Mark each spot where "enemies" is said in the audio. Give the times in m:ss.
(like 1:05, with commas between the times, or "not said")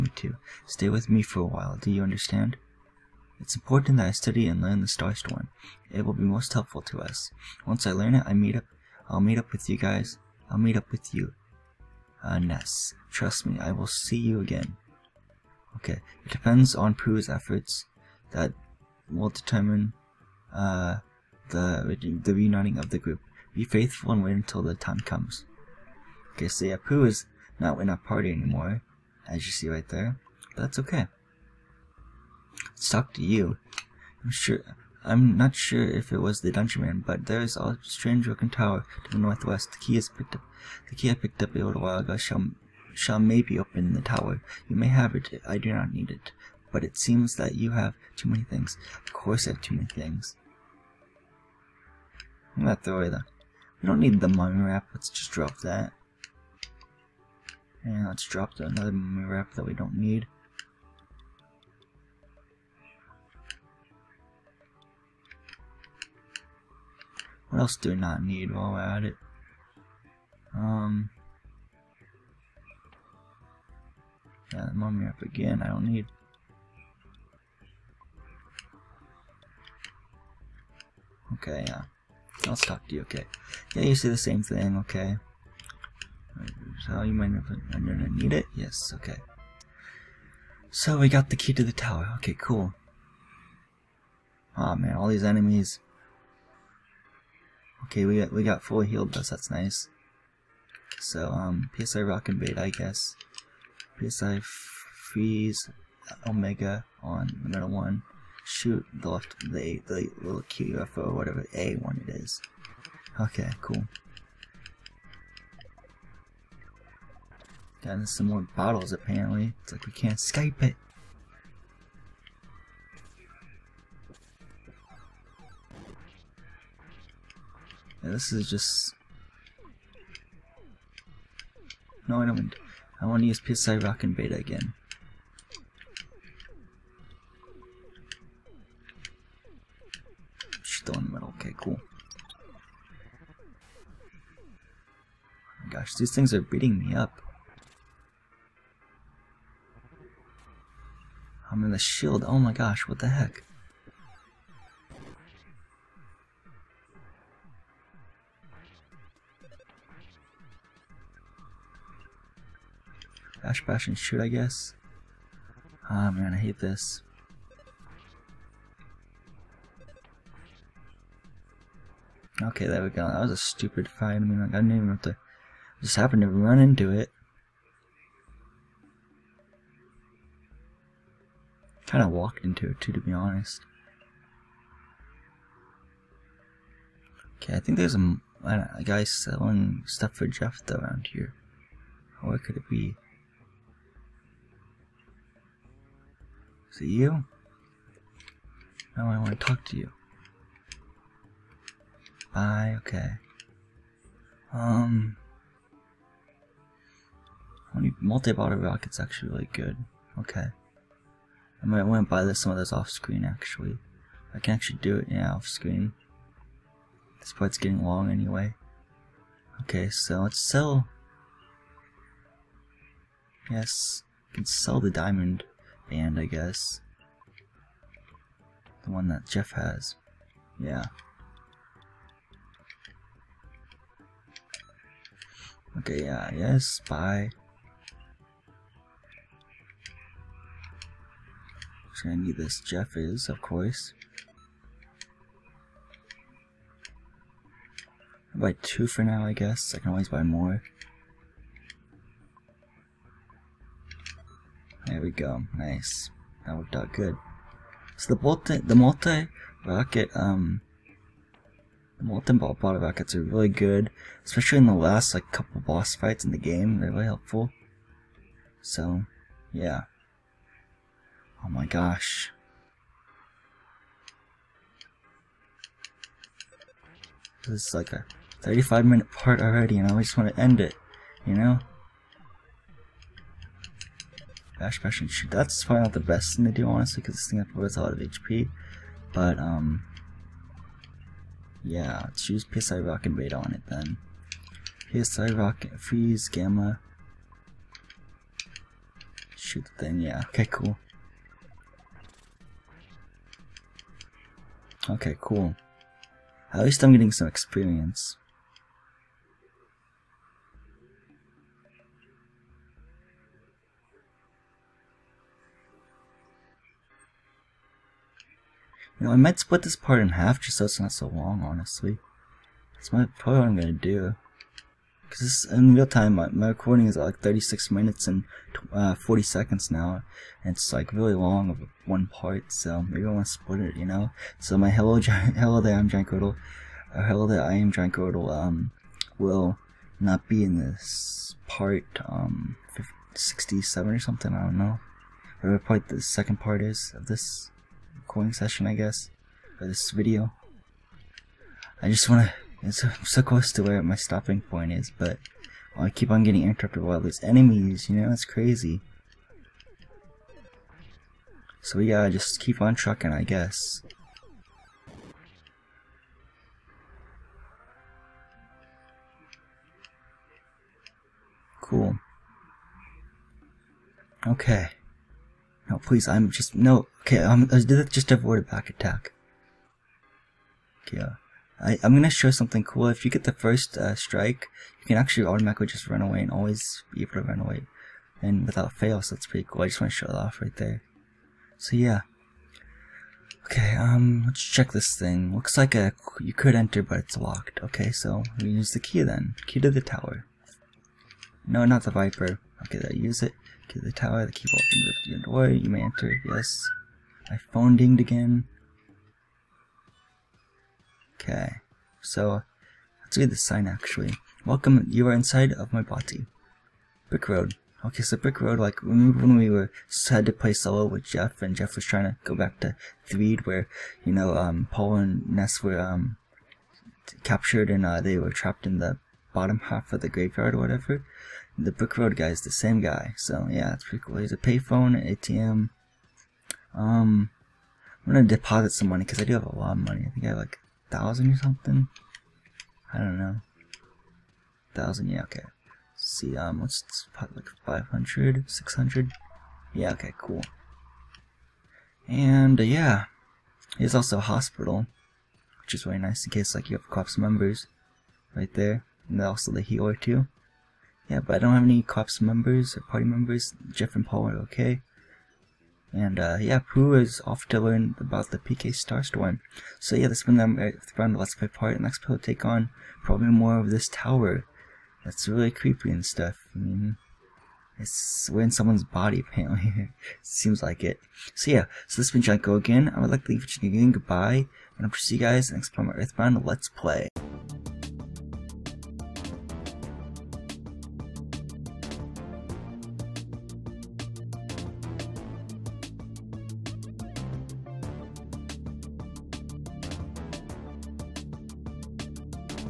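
1:35, 5:57.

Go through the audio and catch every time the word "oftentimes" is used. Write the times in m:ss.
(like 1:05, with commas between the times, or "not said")
not said.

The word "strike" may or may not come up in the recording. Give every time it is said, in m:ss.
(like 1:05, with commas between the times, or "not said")
6:23.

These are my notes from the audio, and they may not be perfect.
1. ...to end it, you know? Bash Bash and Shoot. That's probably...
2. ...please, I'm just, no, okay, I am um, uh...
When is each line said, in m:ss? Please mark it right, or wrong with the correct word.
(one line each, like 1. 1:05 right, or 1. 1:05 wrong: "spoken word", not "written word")
1. 4:40 right
2. 6:15 right.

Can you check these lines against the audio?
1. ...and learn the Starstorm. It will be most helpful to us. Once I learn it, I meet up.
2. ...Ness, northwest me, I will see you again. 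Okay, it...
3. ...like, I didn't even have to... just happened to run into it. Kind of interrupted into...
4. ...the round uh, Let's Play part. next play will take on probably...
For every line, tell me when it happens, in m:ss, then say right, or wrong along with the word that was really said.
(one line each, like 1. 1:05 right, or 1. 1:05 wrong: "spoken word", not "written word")
1. 0:04 right
2. 0:12 wrong: "trust", not "northwest"
3. 2:54 wrong: "walked", not "interrupted"
4. 7:50 right.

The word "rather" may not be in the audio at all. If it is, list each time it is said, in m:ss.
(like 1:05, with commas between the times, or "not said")
not said.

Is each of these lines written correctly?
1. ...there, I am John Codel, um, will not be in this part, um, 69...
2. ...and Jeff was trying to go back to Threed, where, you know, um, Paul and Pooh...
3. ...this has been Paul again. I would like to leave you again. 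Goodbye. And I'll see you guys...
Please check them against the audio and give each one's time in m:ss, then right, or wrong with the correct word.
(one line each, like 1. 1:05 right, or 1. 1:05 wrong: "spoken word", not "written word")
1. 5:37 wrong: "67", not "69"
2. 7:01 wrong: "Ness", not "Pooh"
3. 8:01 wrong: "Janko", not "Paul".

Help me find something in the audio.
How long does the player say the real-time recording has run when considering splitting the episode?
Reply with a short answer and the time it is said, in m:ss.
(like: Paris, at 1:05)
36 minutes 40 seconds, at 5:27.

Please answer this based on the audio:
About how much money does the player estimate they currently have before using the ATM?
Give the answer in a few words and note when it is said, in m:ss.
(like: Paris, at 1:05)
1000, at 7:20.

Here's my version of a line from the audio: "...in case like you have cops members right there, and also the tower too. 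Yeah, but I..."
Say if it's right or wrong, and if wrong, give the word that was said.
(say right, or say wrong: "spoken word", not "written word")
wrong: "healer", not "tower".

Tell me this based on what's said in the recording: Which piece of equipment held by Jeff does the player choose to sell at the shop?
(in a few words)
diamond band.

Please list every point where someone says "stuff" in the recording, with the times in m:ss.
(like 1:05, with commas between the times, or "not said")
3:09, 7:56.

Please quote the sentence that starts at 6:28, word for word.
And without fail, so that's pretty cool.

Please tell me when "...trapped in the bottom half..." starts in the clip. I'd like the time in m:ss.
7:08.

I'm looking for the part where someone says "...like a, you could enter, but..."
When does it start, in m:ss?
6:35.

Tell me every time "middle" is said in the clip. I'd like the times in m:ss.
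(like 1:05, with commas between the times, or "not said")
1:47, 2:21.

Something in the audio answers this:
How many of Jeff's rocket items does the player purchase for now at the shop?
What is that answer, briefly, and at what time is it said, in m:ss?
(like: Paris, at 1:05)
2, at 4:08.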